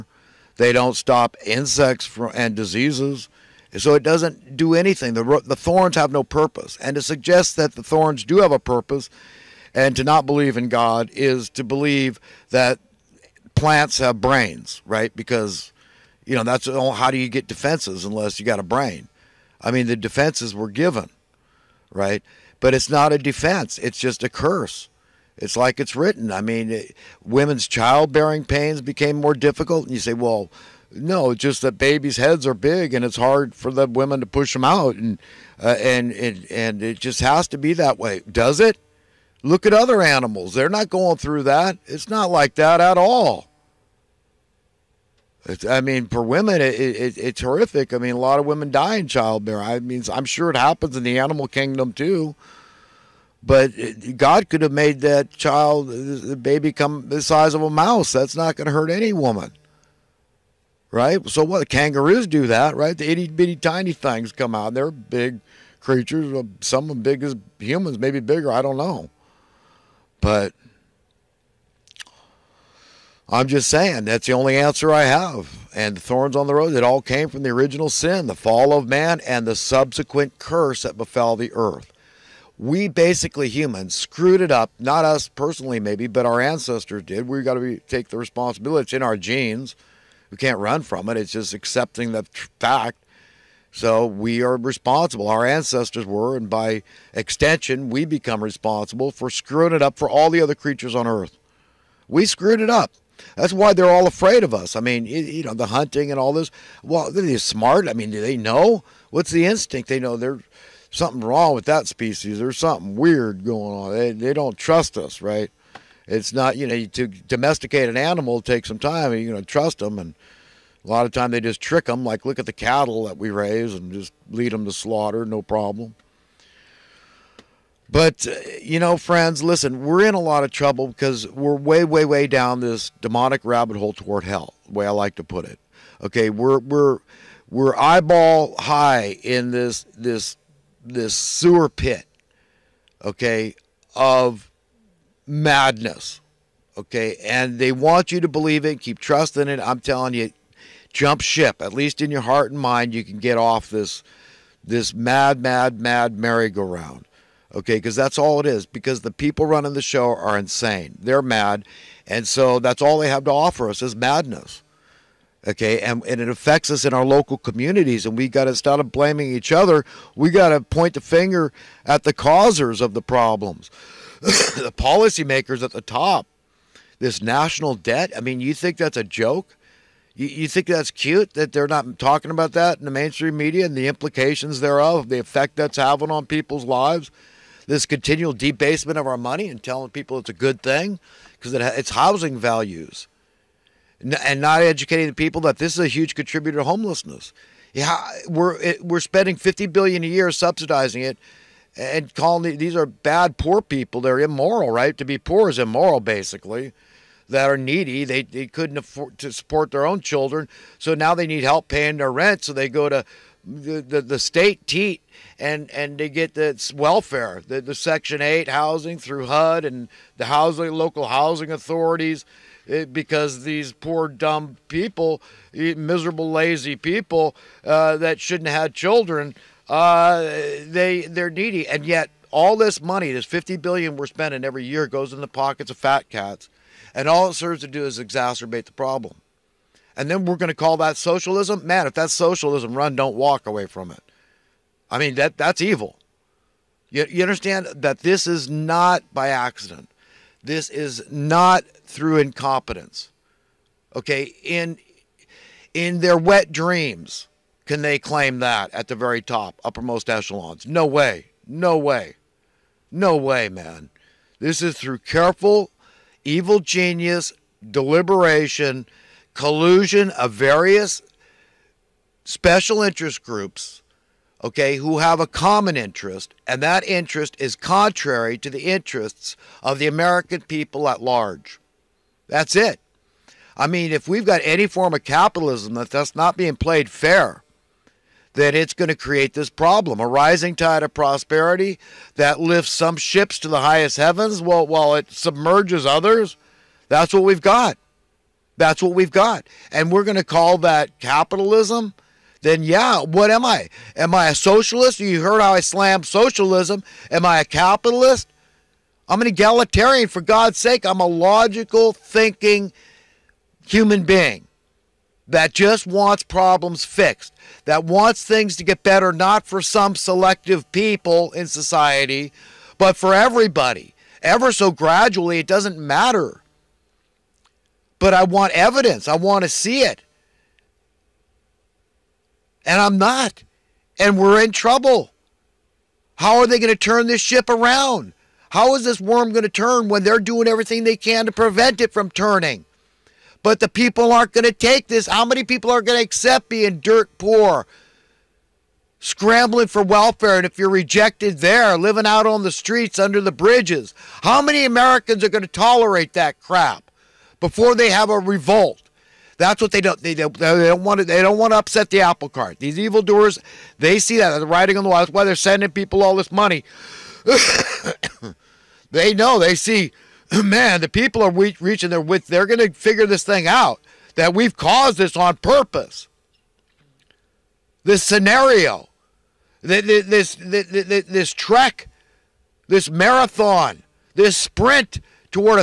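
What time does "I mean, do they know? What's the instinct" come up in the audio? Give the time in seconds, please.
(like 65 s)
107 s.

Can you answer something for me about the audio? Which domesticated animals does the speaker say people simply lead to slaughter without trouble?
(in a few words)
cattle.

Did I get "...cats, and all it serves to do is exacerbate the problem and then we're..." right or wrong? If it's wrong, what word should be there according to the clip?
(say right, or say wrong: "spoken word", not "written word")
right.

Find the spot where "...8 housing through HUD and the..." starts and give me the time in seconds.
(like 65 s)
218 s.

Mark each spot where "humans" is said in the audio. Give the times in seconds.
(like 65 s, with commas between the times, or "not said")
67 s, 83 s, 313 s.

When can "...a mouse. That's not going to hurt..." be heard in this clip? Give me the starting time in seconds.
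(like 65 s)
57 s.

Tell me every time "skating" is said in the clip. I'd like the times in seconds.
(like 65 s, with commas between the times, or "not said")
not said.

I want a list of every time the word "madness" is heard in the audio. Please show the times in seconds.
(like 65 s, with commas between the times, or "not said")
145 s, 163 s.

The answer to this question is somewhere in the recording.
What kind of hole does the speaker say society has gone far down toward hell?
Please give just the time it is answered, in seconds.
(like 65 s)
133 s.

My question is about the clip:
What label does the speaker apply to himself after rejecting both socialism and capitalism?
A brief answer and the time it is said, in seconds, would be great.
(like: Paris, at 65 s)
egalitarian, at 309 s.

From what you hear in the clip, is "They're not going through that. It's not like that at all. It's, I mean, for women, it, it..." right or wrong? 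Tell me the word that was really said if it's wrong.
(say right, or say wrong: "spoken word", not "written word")
right.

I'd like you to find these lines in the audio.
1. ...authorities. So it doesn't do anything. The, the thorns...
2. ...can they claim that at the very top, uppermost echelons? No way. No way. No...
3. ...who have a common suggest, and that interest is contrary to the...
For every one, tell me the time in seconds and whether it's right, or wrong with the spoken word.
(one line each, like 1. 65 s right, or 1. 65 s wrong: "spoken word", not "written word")
1. 2 s wrong: "diseases", not "authorities"
2. 257 s right
3. 274 s wrong: "interest", not "suggest".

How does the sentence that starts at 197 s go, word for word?
Yeah, we're it, we're spending 50 billion a year subsidizing it and calling these are bad poor people.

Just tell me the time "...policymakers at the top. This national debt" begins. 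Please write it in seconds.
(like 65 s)
174 s.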